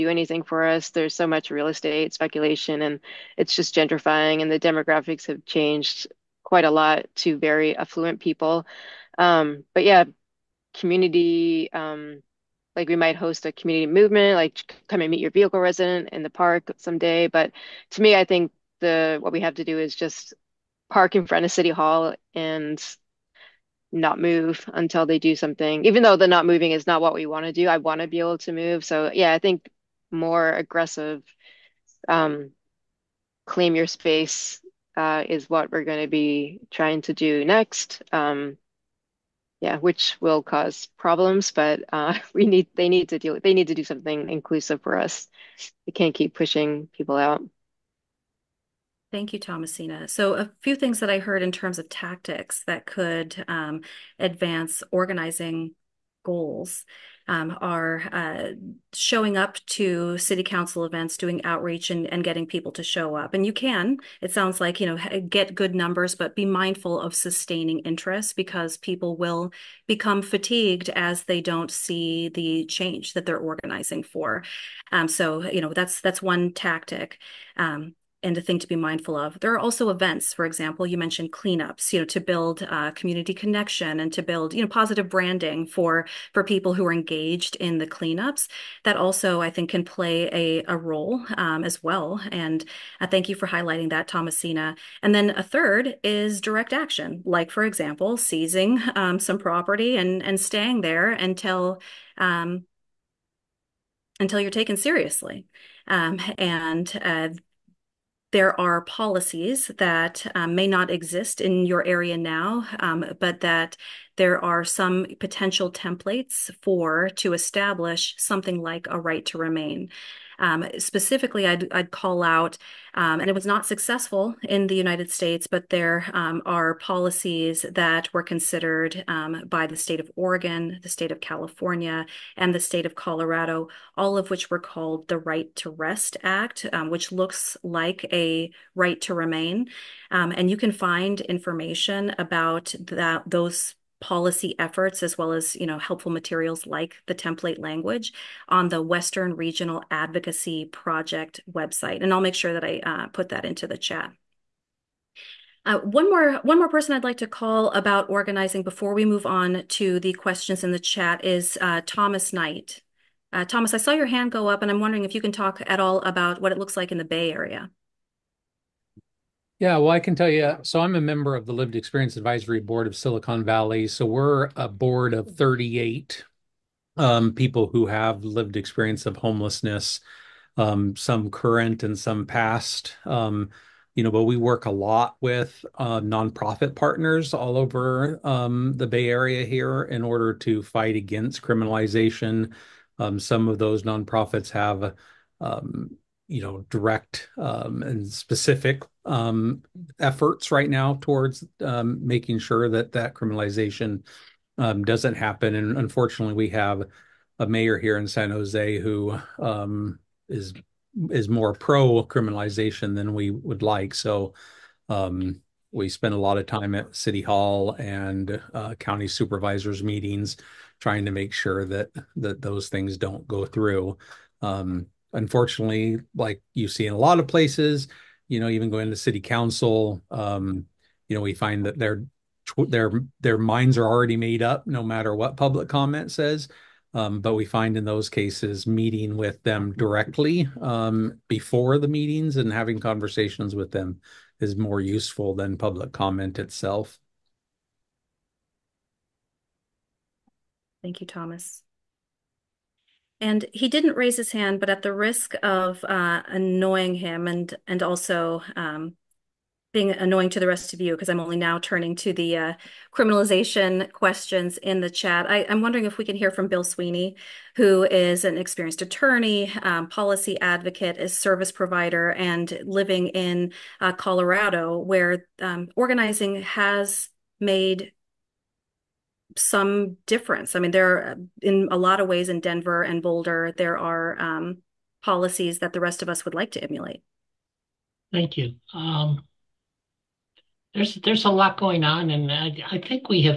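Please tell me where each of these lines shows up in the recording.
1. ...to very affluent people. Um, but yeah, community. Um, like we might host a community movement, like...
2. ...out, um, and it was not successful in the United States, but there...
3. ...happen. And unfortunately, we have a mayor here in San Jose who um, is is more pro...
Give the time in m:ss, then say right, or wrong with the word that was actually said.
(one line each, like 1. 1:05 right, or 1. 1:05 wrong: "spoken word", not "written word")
1. 0:07 right
2. 2:02 right
3. 3:25 right.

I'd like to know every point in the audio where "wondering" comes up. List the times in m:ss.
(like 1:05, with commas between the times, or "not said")
2:44, 4:25.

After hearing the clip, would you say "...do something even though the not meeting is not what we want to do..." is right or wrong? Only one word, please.
wrong.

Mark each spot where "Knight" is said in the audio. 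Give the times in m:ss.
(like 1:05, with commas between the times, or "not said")
2:42.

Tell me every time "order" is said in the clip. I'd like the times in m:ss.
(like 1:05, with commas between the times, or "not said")
3:10.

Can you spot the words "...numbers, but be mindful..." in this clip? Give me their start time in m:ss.
1:05.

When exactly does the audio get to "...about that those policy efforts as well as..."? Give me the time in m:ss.
2:22.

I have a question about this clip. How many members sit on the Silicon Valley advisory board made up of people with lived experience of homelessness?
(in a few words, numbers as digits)
38.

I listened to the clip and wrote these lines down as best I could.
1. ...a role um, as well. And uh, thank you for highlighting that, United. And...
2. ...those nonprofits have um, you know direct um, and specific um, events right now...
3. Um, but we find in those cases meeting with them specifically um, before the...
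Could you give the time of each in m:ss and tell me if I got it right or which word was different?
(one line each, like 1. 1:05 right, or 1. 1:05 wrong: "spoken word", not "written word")
1. 1:30 wrong: "Thomasina", not "United"
2. 3:13 wrong: "efforts", not "events"
3. 3:56 wrong: "directly", not "specifically".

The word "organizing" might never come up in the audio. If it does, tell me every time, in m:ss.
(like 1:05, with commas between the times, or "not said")
0:54, 1:13, 2:38, 4:35.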